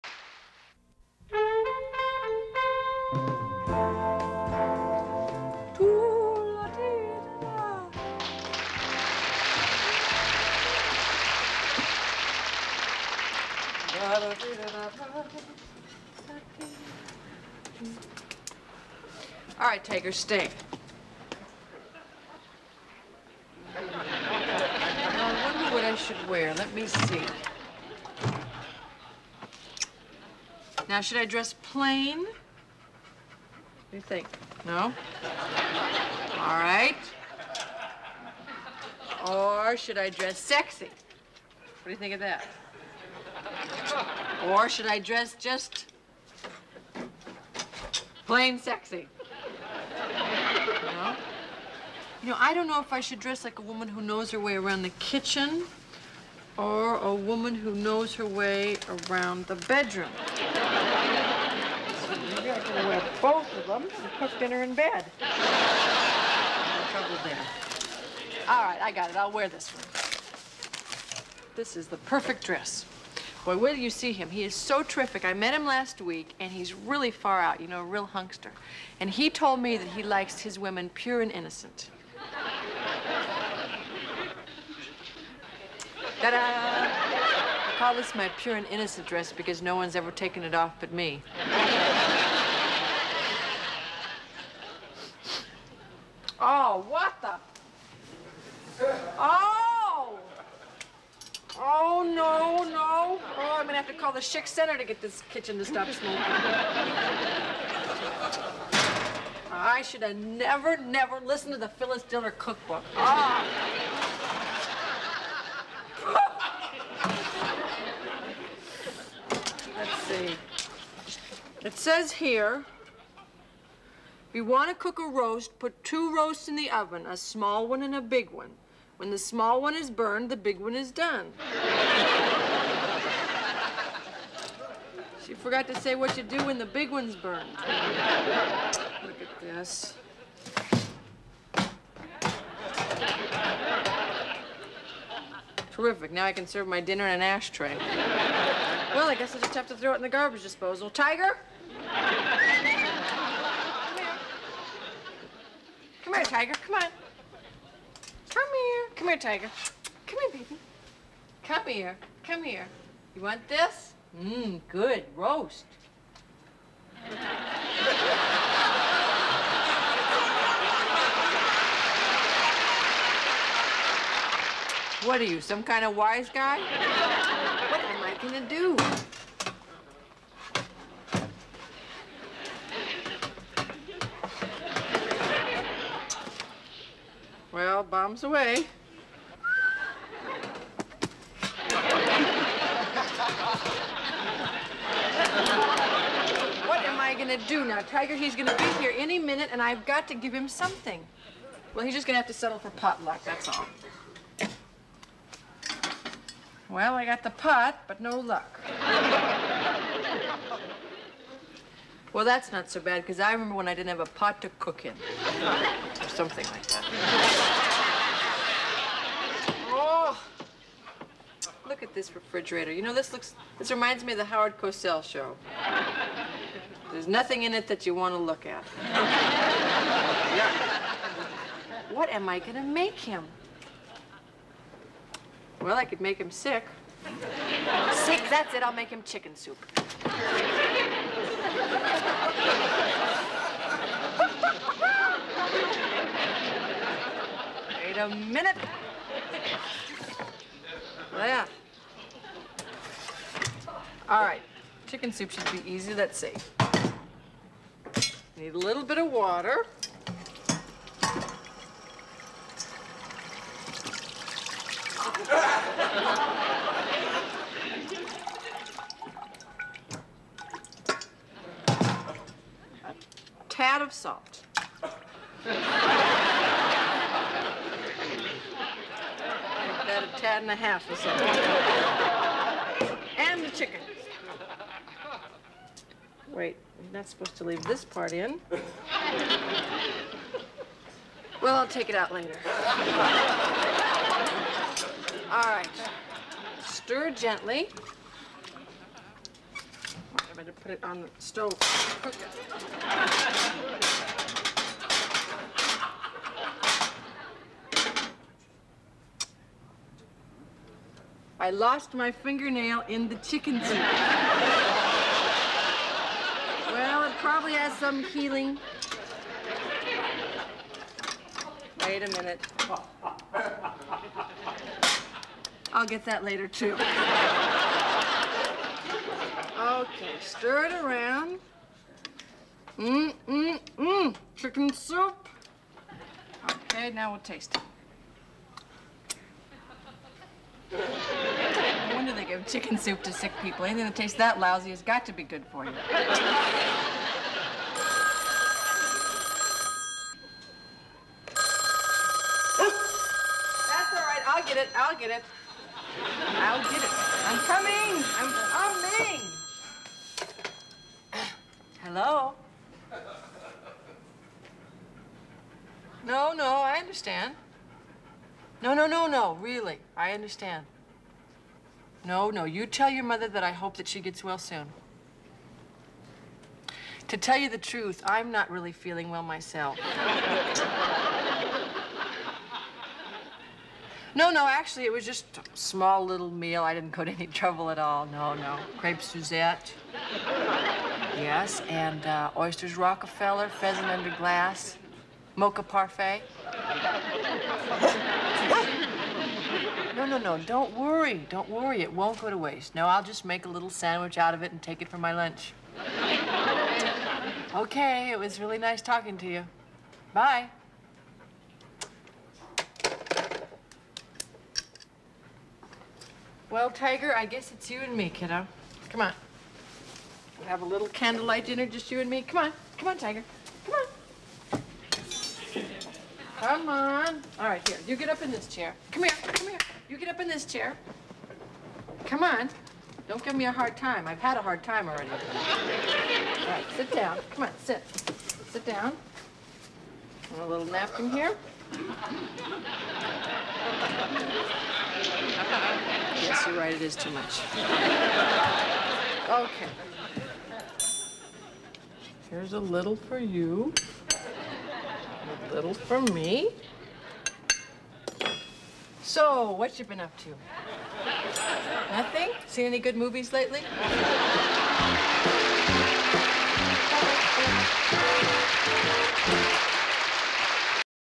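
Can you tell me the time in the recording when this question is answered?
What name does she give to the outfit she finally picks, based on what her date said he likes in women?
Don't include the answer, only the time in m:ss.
1:28.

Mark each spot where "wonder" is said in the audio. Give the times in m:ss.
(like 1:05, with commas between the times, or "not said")
0:25, 5:41.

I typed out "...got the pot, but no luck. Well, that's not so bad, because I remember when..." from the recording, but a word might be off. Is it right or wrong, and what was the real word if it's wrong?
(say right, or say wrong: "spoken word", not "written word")
right.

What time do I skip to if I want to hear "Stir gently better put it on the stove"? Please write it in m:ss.
4:56.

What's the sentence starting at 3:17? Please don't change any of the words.
Tiger, he's gonna be here any minute, and I've got to give him something.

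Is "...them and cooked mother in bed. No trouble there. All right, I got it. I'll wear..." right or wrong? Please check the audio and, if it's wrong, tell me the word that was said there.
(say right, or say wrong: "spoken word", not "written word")
wrong: "dinner", not "mother".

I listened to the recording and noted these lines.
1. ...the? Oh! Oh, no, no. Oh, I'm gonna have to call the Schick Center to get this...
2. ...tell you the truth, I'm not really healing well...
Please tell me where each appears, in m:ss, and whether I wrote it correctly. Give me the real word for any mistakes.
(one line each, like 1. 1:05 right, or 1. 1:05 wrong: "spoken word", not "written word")
1. 1:37 right
2. 6:17 wrong: "feeling", not "healing".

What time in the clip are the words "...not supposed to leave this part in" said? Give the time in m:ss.
4:46.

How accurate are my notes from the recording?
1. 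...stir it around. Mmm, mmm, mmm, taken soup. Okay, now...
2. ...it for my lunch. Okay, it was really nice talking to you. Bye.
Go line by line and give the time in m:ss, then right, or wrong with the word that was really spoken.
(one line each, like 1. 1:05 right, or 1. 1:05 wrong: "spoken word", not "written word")
1. 5:30 wrong: "chicken", not "taken"
2. 6:44 right.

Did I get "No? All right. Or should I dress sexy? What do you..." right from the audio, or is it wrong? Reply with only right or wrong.
right.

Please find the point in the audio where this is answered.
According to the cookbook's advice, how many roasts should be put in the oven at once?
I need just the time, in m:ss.
2:05.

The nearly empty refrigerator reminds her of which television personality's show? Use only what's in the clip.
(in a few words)
Howard Cosell.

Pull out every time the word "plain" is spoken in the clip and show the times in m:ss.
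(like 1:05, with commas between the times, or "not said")
0:31, 0:48.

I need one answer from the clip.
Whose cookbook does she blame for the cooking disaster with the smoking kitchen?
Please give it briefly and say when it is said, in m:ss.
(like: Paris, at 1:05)
Phyllis Diller, at 1:51.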